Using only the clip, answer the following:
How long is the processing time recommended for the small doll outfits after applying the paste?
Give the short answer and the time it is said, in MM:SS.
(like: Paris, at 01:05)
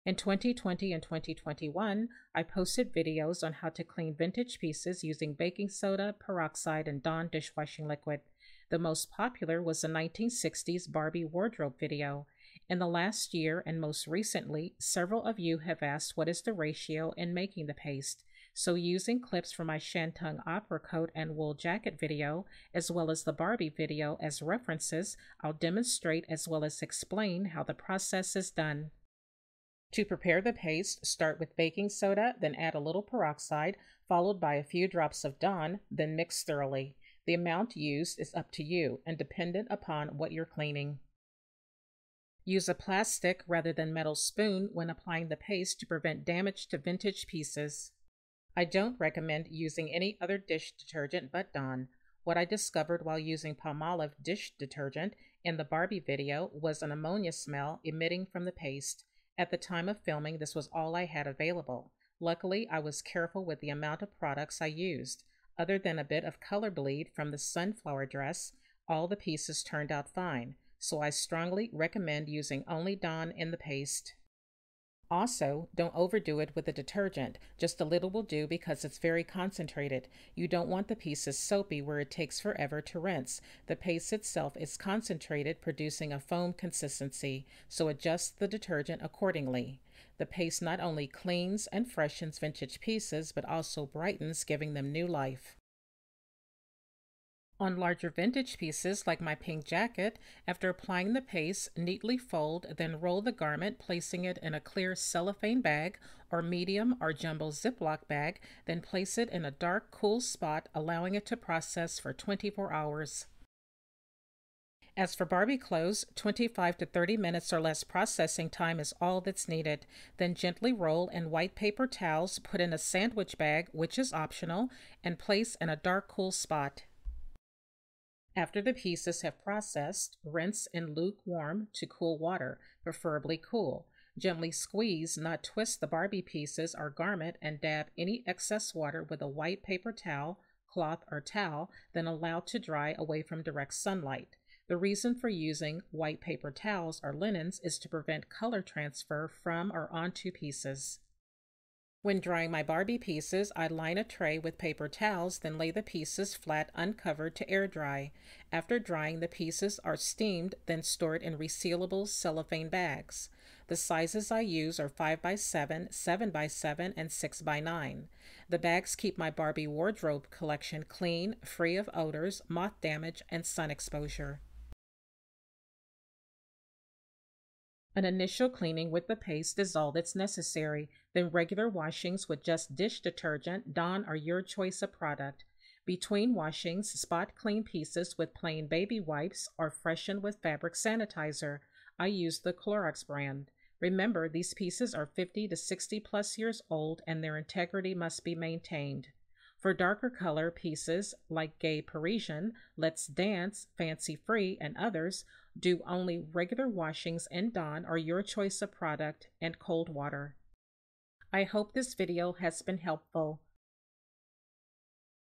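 25 to 30 minutes, at 01:56.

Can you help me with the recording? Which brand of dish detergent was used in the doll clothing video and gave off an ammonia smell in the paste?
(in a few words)
Palmolive.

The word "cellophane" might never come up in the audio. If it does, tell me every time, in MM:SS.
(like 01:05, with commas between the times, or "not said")
01:44, 02:42.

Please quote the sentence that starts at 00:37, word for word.
The amount used is up to you and dependent upon what you're cleaning.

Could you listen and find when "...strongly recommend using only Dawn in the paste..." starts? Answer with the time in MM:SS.
01:11.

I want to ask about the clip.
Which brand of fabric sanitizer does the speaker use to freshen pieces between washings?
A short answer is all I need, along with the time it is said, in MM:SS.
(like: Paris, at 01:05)
Clorox, at 03:12.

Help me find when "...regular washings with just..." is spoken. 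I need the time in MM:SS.
03:01.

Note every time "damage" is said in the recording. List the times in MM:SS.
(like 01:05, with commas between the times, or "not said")
00:46, 02:52.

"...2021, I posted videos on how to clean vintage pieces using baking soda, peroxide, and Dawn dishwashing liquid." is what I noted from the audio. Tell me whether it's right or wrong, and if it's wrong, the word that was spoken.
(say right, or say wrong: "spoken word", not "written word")
right.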